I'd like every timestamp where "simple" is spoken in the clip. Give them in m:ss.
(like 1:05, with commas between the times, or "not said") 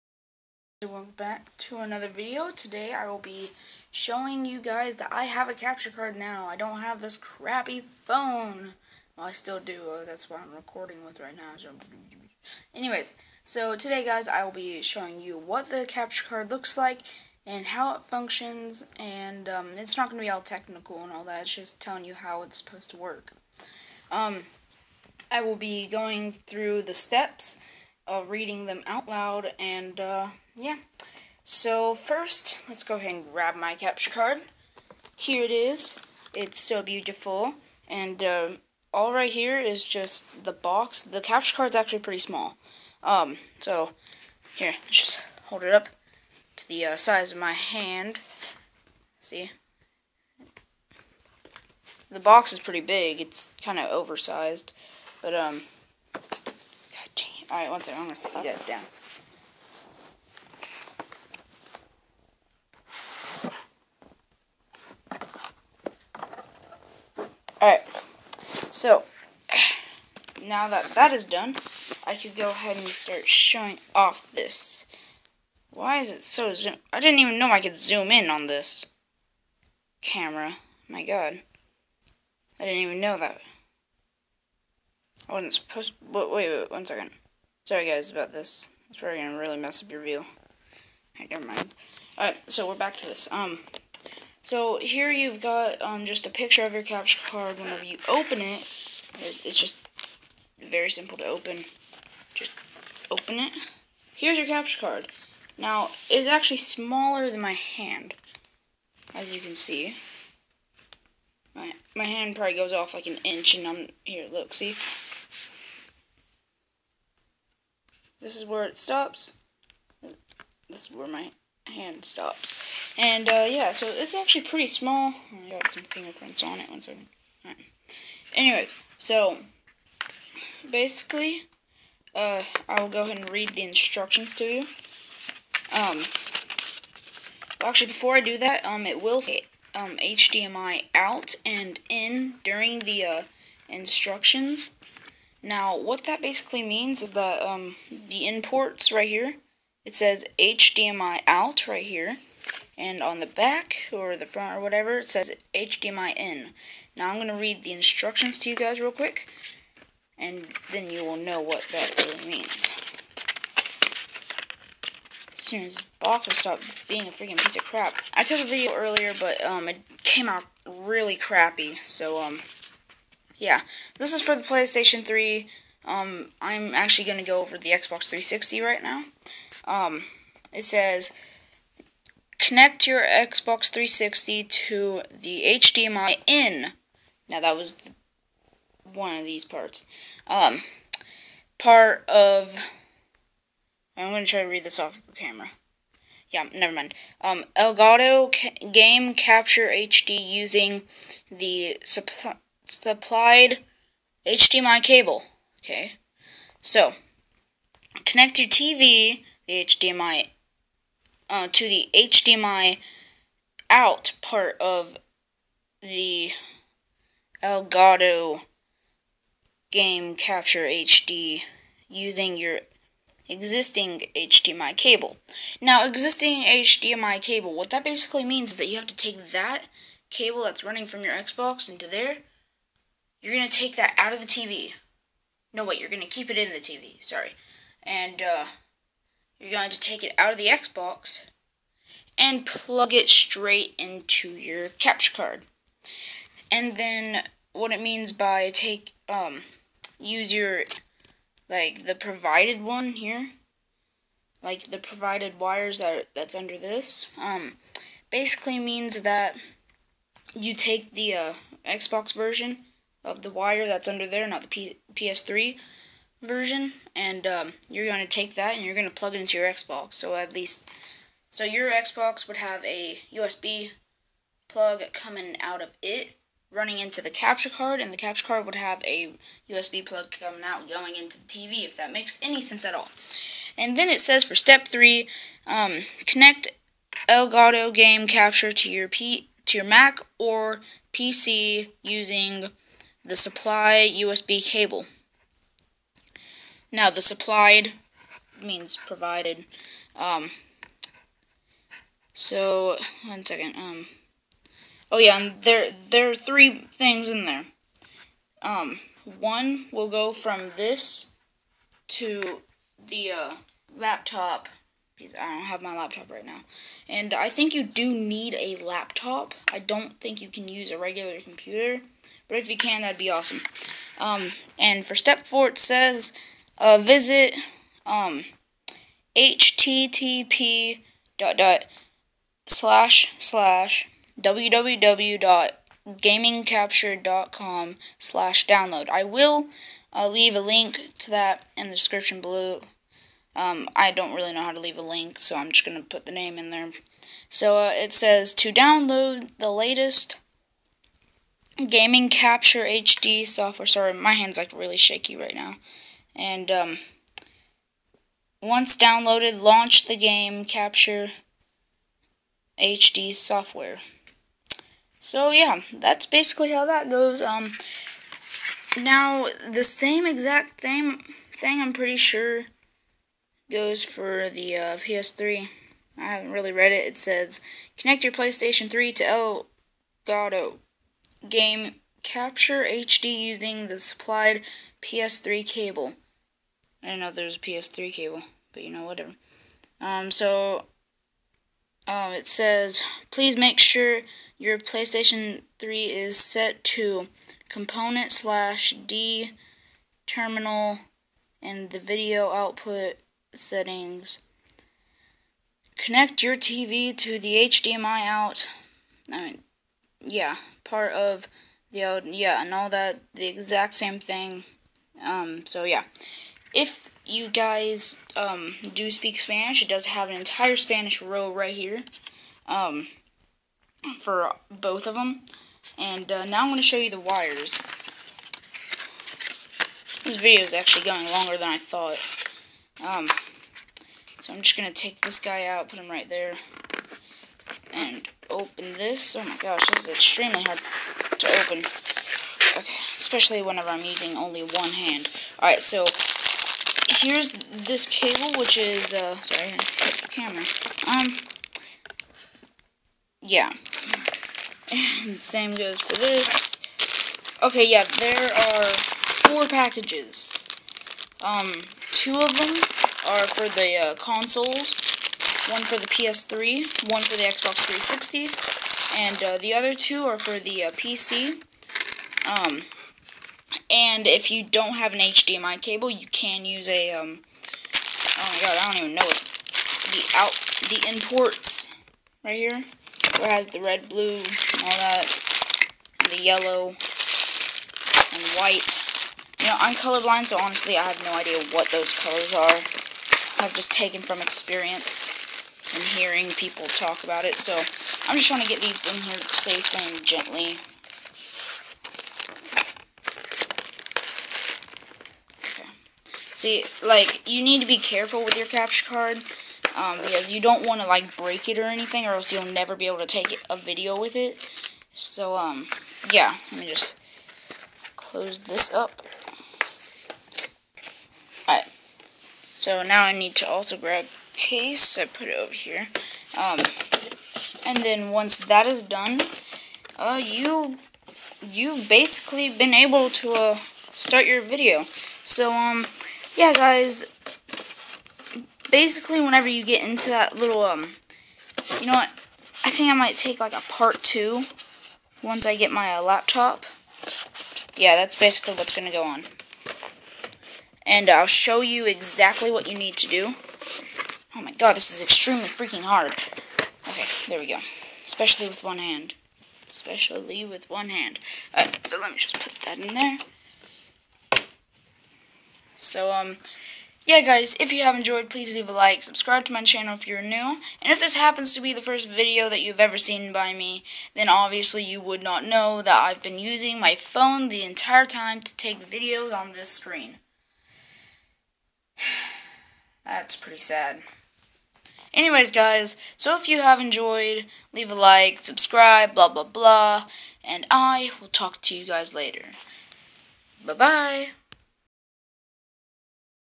1:40.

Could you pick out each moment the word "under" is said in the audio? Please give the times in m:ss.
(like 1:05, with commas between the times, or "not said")
4:16, 4:23.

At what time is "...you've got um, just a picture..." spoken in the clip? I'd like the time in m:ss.
1:35.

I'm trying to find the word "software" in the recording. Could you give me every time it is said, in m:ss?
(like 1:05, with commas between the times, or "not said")
5:53, 6:03.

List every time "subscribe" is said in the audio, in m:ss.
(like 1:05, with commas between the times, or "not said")
9:29, 9:48.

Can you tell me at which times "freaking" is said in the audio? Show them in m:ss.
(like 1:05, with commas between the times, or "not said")
2:47, 9:15.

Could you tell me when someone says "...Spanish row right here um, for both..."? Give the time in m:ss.
7:00.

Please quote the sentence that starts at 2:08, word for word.
Anyways, so, basically, uh, I'll go ahead and read the instructions to you.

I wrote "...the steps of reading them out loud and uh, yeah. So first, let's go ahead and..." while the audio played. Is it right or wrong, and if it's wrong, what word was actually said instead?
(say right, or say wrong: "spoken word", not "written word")
right.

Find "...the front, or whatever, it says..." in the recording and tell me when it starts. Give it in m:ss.
2:34.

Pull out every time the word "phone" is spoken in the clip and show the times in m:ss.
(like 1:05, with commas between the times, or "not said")
0:07, 9:36.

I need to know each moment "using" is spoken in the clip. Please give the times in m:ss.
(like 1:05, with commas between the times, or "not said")
3:20, 3:41, 4:51, 6:23, 7:23, 9:36.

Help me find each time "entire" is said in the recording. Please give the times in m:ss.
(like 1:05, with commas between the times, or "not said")
7:00, 9:37.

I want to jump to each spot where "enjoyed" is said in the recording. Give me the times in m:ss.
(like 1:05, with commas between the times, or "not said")
9:27, 9:46.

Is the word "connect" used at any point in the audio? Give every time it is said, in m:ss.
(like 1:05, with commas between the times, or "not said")
3:02, 3:28, 4:46, 6:17, 6:45.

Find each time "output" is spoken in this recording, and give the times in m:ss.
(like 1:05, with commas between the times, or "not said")
6:42.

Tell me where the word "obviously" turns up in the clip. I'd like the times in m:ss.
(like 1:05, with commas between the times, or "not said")
9:34.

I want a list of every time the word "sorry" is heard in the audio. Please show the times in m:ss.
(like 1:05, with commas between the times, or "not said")
1:27, 3:57, 5:53, 7:29.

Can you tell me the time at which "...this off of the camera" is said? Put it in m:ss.
3:14.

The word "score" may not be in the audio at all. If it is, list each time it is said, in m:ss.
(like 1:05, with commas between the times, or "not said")
not said.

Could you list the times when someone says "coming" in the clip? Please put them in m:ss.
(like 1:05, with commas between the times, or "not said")
4:34, 4:40.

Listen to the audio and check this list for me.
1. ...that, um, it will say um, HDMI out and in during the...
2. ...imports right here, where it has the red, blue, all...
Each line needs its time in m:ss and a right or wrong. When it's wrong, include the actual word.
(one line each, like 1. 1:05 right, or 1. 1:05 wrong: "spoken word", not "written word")
1. 2:18 right
2. 8:00 right.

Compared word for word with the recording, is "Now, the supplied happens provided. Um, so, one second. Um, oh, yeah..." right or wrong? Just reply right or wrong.
wrong.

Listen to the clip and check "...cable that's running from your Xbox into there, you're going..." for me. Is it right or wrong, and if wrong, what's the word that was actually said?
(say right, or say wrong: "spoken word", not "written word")
right.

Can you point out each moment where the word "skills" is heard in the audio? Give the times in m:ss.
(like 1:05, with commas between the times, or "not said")
not said.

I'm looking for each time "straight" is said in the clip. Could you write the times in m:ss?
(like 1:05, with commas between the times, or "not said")
4:03.